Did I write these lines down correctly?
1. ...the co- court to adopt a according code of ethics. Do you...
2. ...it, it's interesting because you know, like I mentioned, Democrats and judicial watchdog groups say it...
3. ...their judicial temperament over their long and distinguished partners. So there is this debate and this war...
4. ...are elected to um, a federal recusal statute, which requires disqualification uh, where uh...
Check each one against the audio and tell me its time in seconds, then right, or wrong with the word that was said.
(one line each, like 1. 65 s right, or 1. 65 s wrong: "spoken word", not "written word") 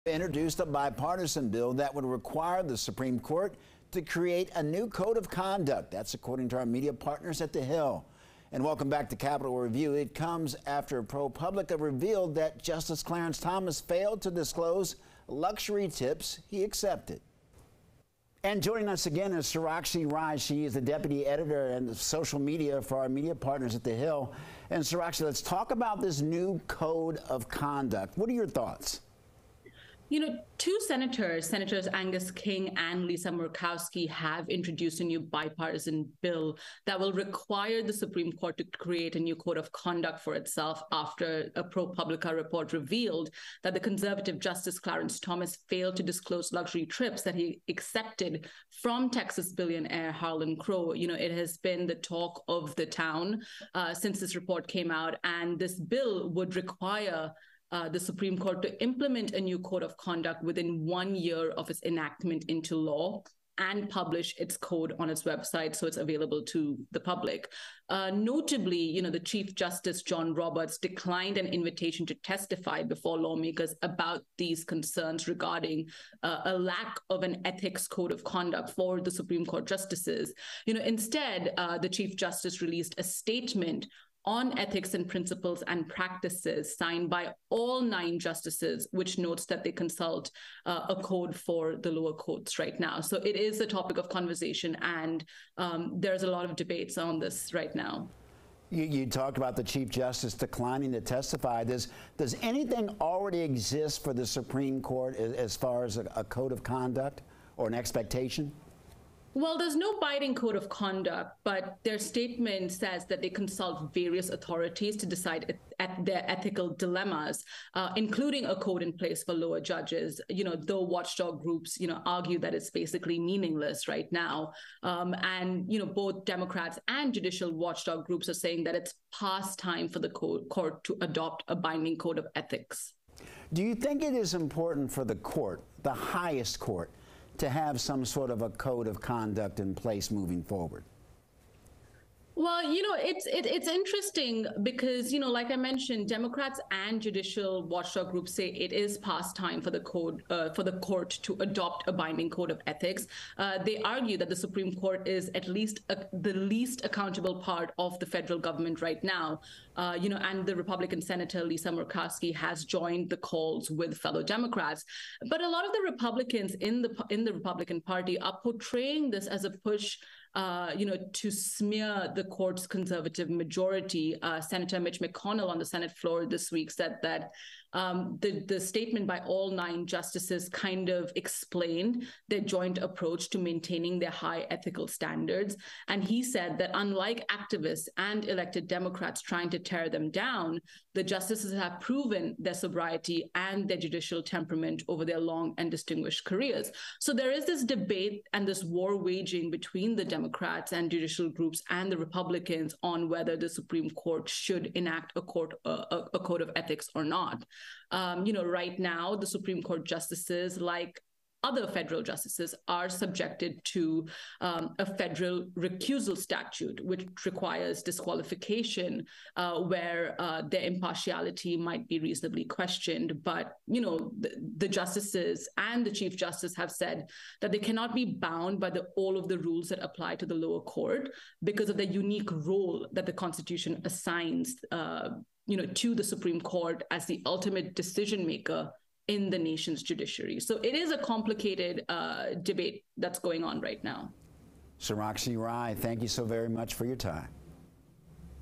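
1. 129 s wrong: "binding", not "according"
2. 143 s right
3. 193 s wrong: "careers", not "partners"
4. 212 s wrong: "subjected", not "elected".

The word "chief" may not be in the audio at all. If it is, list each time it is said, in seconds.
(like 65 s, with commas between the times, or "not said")
69 s, 81 s, 99 s, 225 s.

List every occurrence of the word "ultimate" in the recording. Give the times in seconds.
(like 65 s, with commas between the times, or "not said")
237 s.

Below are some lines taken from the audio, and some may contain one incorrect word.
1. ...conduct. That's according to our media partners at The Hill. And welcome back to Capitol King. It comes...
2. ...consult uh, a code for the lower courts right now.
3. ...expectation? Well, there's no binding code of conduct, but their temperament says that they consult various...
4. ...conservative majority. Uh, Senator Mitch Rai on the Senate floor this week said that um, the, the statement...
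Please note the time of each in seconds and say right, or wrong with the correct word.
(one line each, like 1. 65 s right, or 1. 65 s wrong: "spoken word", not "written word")
1. 5 s wrong: "Review", not "King"
2. 89 s right
3. 107 s wrong: "statement", not "temperament"
4. 172 s wrong: "McConnell", not "Rai".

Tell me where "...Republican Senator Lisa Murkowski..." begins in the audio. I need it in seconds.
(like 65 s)
160 s.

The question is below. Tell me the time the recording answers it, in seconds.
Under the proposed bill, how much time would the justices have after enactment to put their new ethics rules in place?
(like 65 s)
60 s.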